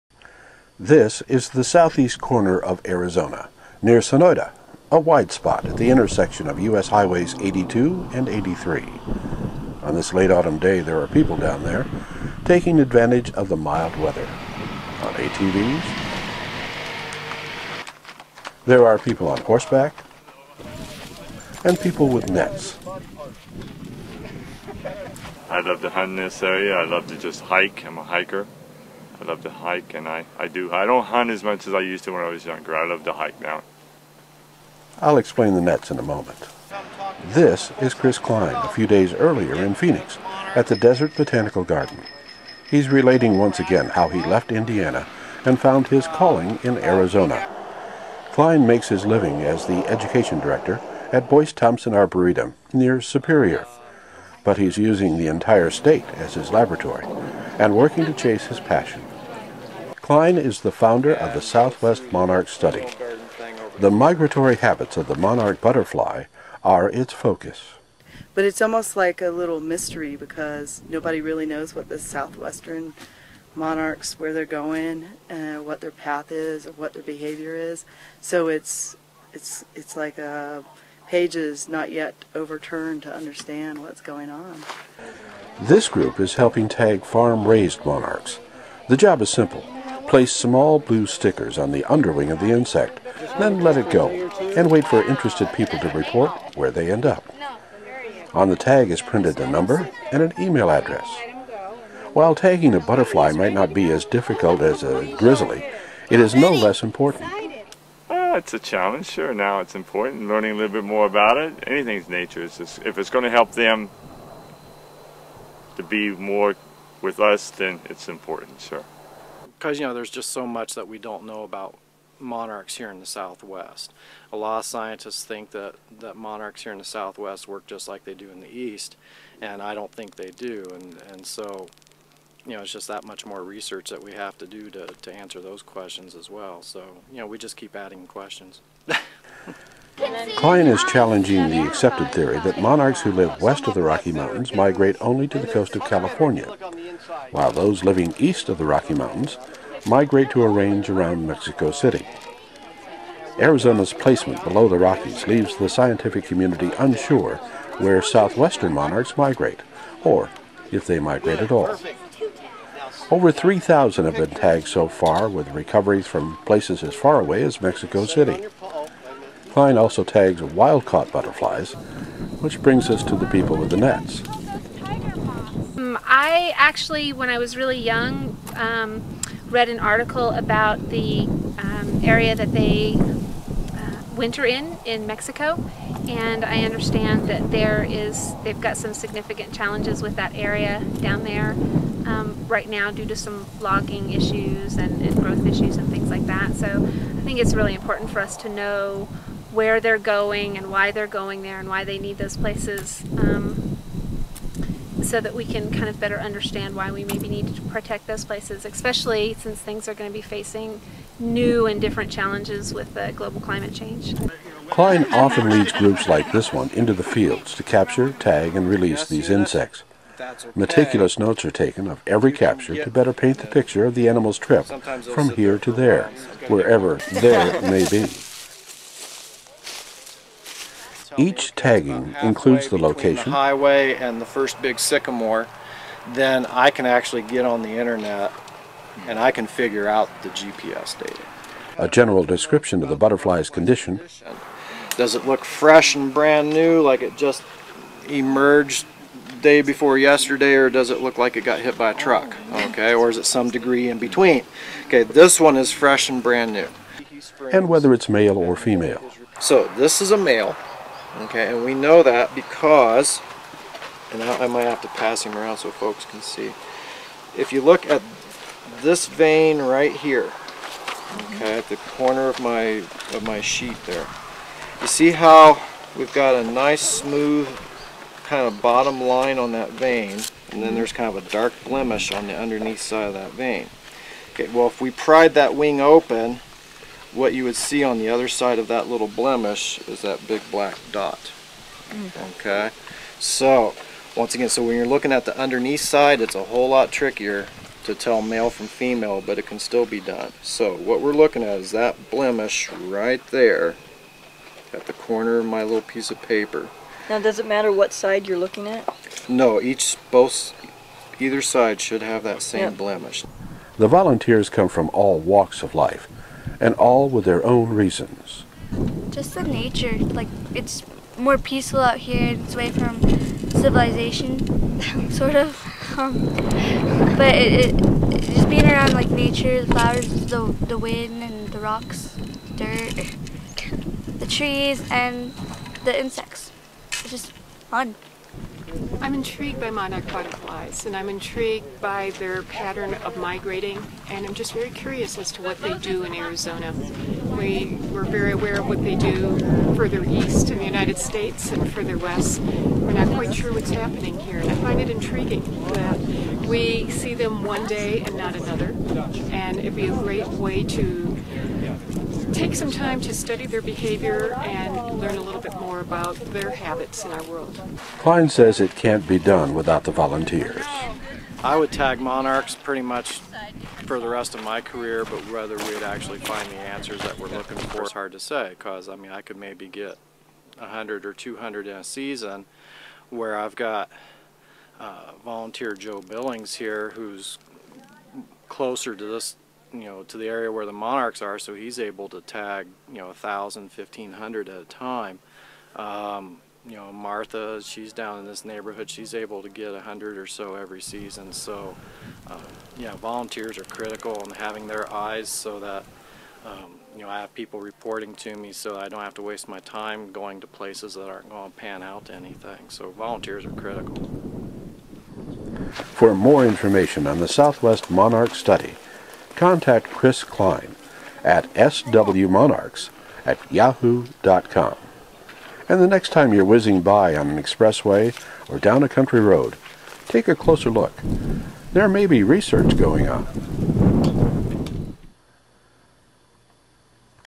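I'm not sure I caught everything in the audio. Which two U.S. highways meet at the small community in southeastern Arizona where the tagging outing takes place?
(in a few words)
82 and 83.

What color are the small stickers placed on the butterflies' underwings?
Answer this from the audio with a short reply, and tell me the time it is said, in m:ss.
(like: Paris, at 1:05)
Blue, at 1:30.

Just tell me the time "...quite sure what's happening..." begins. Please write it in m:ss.
5:53.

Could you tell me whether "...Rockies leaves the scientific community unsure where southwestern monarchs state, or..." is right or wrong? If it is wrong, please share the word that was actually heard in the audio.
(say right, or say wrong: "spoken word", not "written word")
wrong: "migrate", not "state".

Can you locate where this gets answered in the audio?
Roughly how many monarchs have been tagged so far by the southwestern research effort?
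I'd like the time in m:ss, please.
2:43.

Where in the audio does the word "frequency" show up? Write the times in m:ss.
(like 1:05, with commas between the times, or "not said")
not said.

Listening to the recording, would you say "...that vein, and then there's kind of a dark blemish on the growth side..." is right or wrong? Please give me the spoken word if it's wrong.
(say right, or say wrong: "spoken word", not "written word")
wrong: "underneath", not "growth".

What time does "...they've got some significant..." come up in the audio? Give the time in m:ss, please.
3:08.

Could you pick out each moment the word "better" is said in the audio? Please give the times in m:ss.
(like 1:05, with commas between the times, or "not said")
3:25, 3:42.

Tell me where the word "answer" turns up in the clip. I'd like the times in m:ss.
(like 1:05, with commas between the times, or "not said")
2:15, 6:16.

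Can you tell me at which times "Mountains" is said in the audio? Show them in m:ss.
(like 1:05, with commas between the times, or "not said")
2:24, 2:28.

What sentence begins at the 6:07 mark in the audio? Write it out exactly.
Kline says it can't be done without the volunteers.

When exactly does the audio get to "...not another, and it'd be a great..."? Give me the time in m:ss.
5:58.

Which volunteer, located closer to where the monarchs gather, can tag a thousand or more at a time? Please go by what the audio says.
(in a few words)
Joe Billings.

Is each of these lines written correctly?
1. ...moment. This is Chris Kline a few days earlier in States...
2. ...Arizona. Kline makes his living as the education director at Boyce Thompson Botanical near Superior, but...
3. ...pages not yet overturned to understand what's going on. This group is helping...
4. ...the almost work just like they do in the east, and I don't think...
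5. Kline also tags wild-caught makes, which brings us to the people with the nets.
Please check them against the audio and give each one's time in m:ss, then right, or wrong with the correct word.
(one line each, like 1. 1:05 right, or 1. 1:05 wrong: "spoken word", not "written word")
1. 0:36 wrong: "Phoenix", not "States"
2. 0:46 wrong: "Arboretum", not "Botanical"
3. 1:21 right
4. 2:06 wrong: "southwest", not "almost"
5. 2:49 wrong: "butterflies", not "makes".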